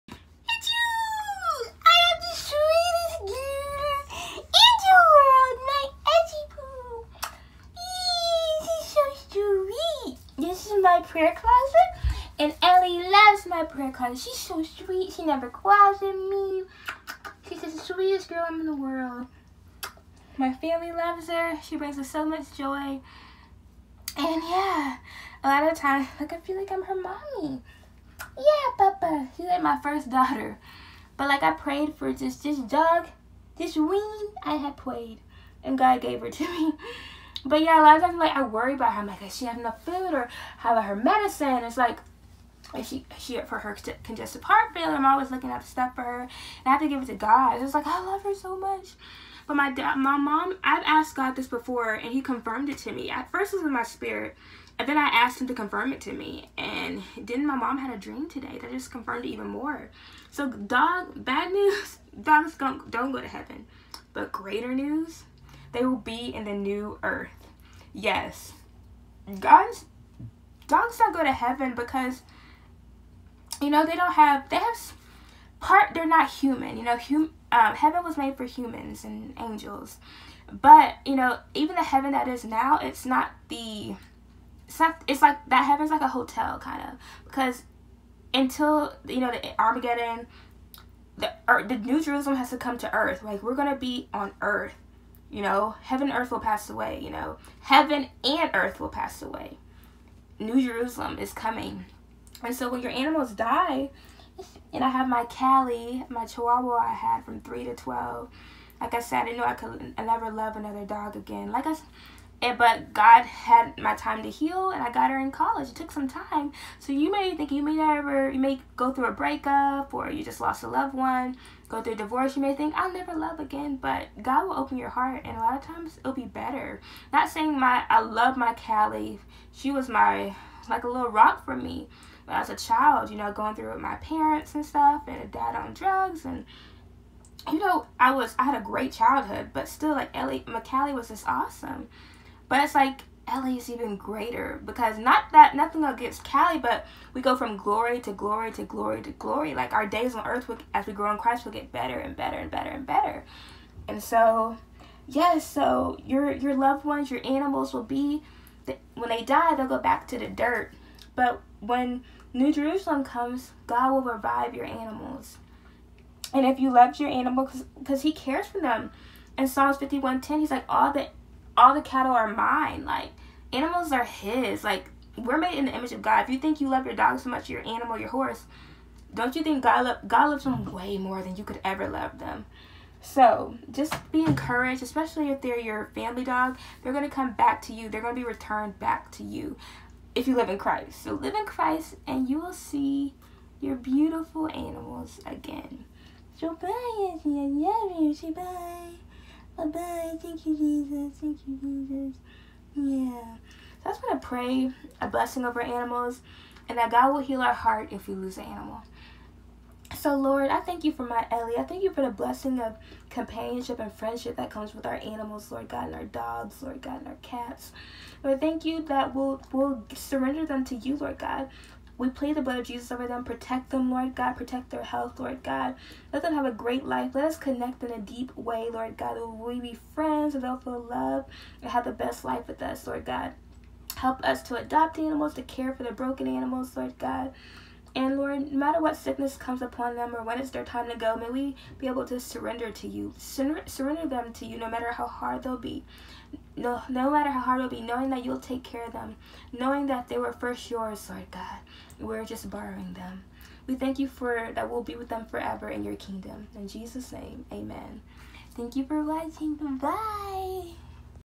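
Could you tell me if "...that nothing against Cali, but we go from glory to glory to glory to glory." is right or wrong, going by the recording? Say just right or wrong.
right.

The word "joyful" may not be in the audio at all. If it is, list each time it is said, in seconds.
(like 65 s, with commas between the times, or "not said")
not said.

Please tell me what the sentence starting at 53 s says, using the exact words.
At first, it was in my spirit, and then I asked Him to confirm it to me.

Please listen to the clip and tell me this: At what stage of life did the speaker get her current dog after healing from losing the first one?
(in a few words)
In college.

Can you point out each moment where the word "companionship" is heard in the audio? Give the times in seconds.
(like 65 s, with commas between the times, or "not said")
213 s.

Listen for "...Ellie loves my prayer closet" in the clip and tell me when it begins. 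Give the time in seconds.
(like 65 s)
12 s.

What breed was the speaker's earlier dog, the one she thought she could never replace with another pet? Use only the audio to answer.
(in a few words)
Chihuahua.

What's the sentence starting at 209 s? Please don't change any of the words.
So, Lord, I thank you for my Ellie.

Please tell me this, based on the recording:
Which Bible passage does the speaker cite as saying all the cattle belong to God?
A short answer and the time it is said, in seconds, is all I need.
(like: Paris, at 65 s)
Psalms 51:10, at 169 s.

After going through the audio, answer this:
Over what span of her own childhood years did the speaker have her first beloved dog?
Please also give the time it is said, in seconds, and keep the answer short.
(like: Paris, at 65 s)
3 to 12, at 107 s.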